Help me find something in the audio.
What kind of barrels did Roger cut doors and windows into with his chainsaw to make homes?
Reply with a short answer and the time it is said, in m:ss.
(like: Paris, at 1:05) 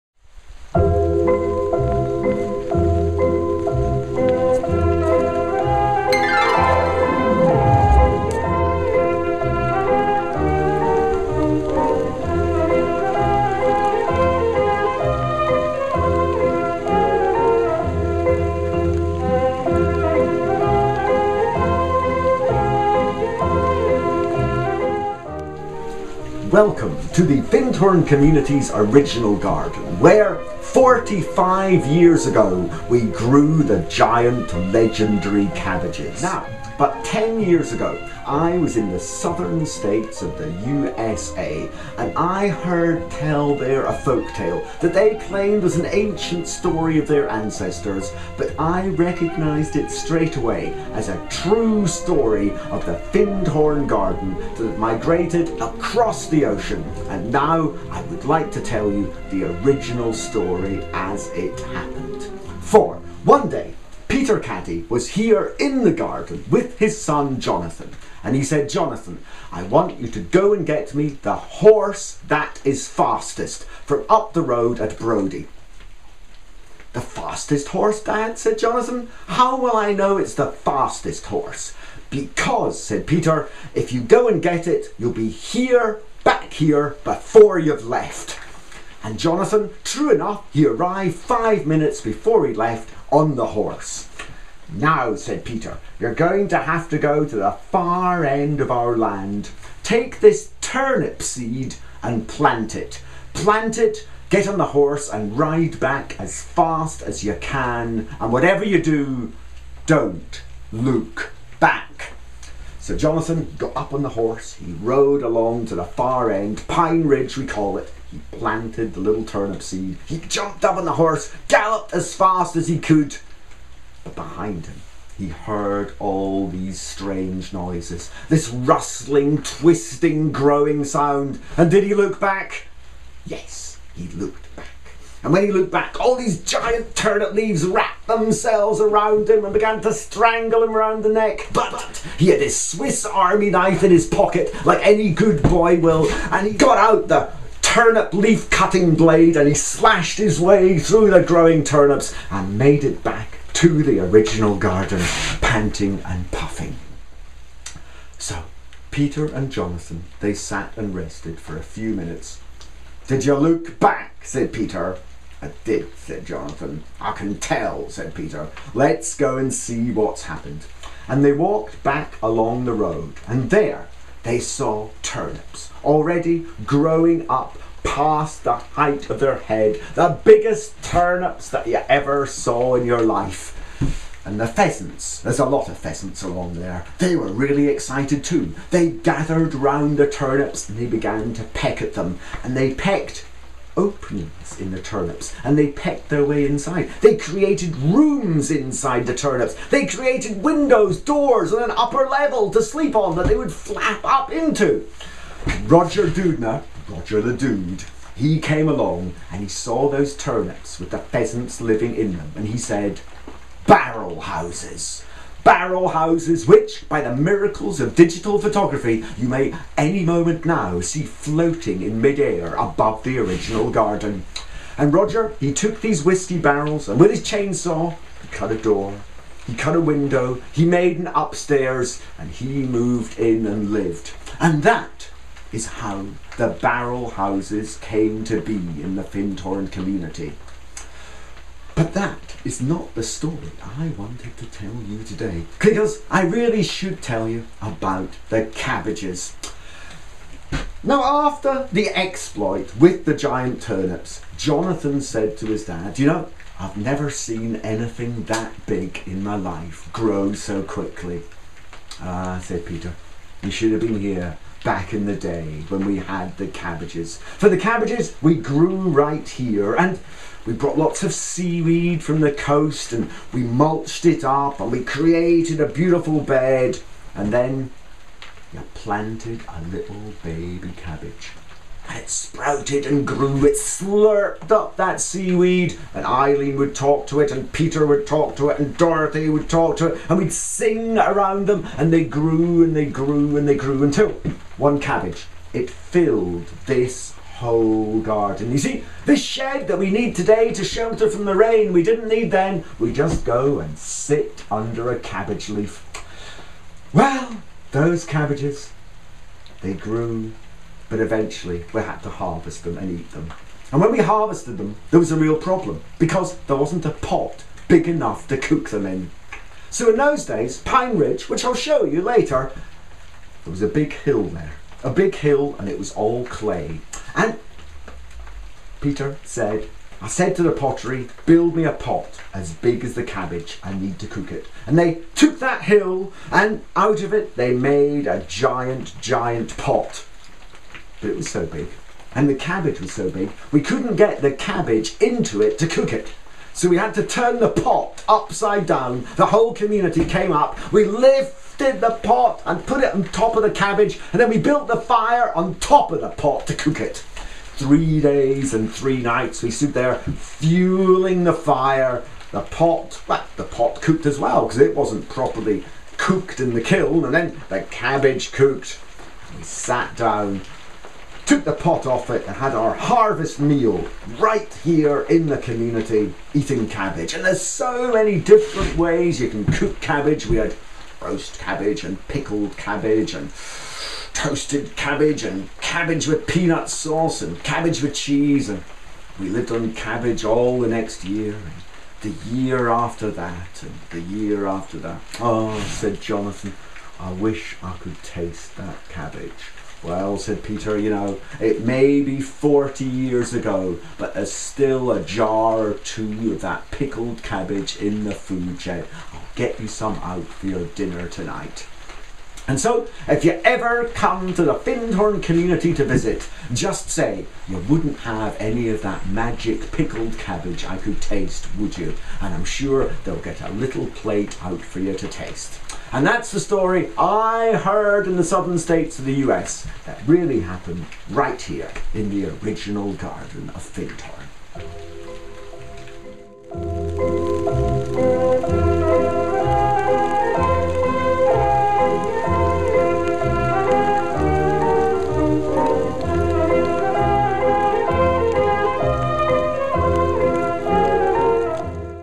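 Whiskey barrels, at 3:46.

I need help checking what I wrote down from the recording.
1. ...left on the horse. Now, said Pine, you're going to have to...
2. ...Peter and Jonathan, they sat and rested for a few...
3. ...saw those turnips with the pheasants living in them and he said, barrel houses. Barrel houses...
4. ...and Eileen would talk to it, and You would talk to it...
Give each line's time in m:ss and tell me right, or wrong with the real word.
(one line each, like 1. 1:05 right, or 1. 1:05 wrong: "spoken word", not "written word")
1. 1:32 wrong: "Peter", not "Pine"
2. 2:38 right
3. 3:29 right
4. 4:45 wrong: "Peter", not "You".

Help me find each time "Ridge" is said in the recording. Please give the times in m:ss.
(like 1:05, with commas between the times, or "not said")
1:57, 5:20.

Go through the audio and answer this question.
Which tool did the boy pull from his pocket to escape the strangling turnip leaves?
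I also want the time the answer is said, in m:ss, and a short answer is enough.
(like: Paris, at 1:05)
Swiss army knife, at 2:22.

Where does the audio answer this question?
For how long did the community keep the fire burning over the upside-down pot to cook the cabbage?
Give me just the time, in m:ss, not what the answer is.
5:57.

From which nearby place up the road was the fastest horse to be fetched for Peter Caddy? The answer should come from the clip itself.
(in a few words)
Brodie.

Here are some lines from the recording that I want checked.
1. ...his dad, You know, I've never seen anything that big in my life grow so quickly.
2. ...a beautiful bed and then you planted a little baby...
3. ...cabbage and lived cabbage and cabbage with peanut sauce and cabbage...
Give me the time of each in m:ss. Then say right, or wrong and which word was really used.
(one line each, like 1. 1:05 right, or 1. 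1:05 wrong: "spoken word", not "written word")
1. 4:15 right
2. 4:35 right
3. 6:22 wrong: "toasted", not "lived".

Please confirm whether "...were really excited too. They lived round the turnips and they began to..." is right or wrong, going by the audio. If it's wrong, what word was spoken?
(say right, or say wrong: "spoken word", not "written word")
wrong: "gathered", not "lived".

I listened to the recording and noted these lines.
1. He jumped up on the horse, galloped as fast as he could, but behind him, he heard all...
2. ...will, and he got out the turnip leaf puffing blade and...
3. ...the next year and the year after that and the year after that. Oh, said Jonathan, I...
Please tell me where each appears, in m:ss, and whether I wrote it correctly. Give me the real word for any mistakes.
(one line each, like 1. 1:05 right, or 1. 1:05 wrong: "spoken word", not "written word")
1. 2:00 right
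2. 2:25 wrong: "cutting", not "puffing"
3. 6:30 right.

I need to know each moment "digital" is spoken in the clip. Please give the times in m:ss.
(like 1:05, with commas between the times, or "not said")
3:37.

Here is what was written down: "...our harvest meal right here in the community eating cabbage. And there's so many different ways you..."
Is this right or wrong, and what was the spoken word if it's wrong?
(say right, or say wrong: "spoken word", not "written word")
right.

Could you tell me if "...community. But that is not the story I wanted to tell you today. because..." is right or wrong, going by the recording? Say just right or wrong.
right.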